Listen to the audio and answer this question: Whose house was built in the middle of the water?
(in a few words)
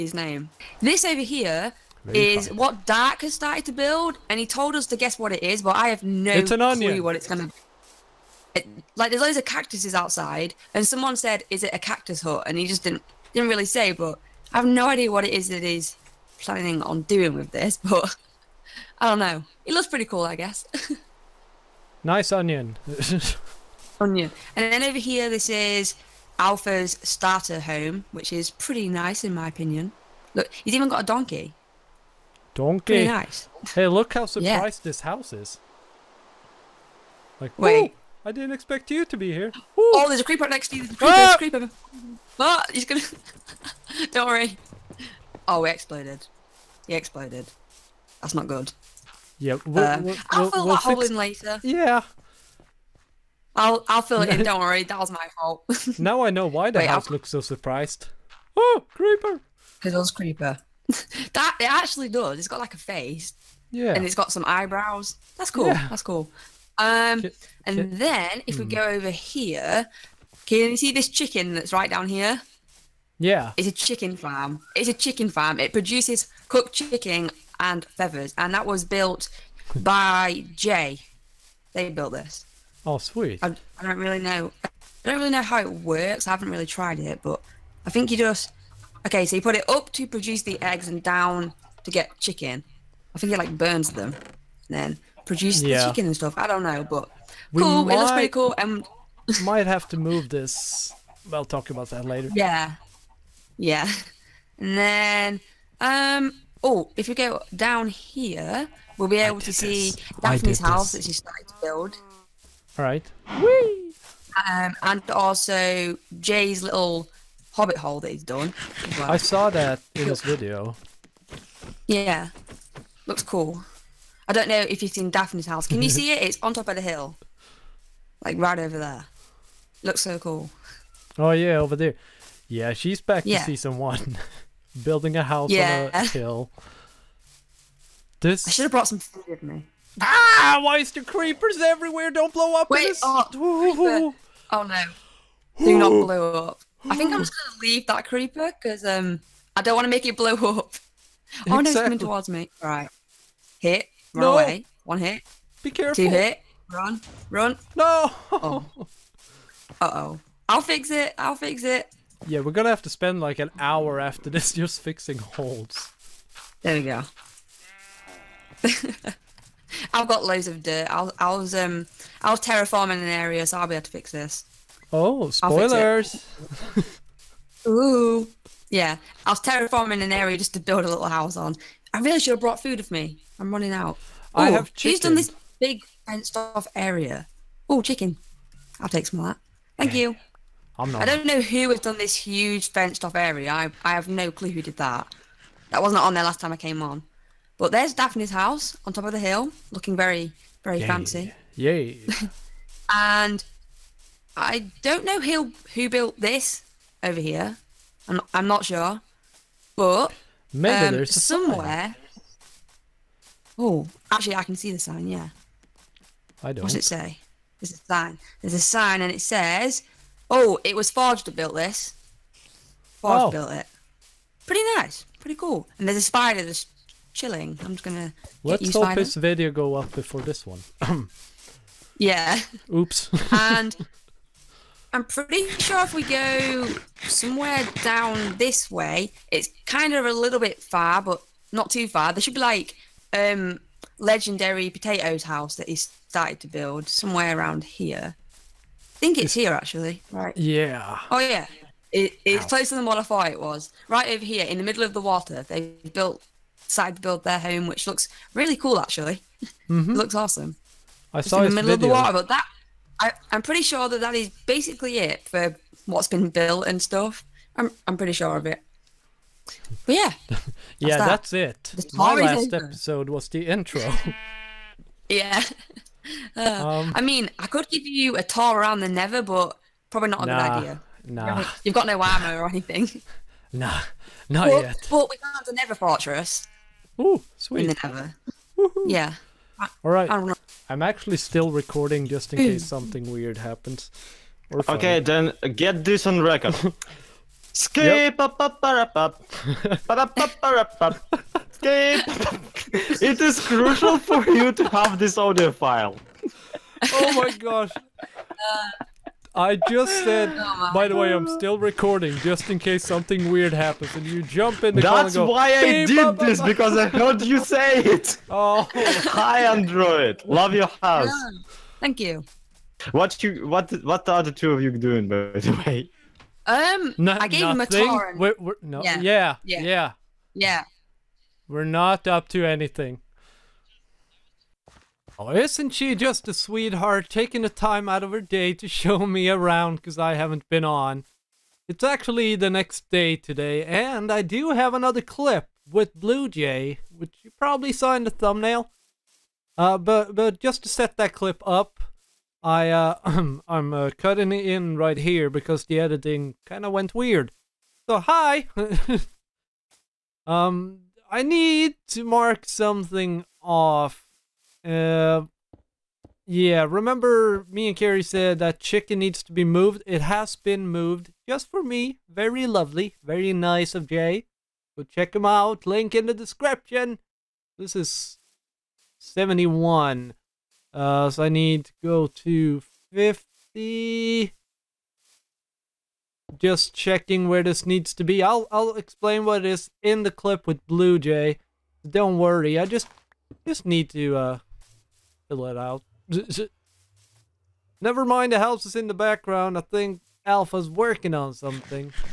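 legendary potatoes.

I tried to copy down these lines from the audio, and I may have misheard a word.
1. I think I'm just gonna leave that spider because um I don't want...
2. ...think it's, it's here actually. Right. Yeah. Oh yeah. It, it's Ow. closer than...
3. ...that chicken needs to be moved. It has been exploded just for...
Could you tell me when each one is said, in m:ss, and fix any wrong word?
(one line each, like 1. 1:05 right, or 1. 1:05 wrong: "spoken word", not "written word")
1. 2:26 wrong: "creeper", not "spider"
2. 4:08 right
3. 6:08 wrong: "moved", not "exploded".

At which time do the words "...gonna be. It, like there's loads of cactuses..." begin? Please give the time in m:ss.
0:07.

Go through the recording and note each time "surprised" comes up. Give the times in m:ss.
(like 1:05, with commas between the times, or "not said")
0:34, 0:57.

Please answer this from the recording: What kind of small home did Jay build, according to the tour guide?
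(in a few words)
hobbit hole.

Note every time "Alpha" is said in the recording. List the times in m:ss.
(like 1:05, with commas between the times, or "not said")
0:26, 6:40.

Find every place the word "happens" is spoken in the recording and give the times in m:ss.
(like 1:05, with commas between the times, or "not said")
4:53, 5:13.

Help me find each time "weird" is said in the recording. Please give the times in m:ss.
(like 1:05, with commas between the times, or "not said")
4:53, 5:13, 5:56.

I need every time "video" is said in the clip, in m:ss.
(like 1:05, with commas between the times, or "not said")
2:00, 3:49, 4:21.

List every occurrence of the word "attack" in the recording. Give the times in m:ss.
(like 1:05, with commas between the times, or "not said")
not said.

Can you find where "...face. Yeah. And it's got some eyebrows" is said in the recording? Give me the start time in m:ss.
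1:02.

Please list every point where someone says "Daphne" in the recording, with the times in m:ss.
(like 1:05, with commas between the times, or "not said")
1:50, 2:05, 3:17.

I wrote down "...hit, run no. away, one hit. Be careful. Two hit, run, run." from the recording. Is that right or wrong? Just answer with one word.
right.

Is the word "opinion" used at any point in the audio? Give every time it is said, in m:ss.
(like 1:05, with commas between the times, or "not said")
0:29.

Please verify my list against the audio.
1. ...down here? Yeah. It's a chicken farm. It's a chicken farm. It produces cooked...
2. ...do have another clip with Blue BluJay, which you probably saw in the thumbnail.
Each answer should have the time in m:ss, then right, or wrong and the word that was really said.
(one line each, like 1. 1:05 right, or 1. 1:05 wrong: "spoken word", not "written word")
1. 1:11 right
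2. 5:44 wrong: "Jay", not "BluJay".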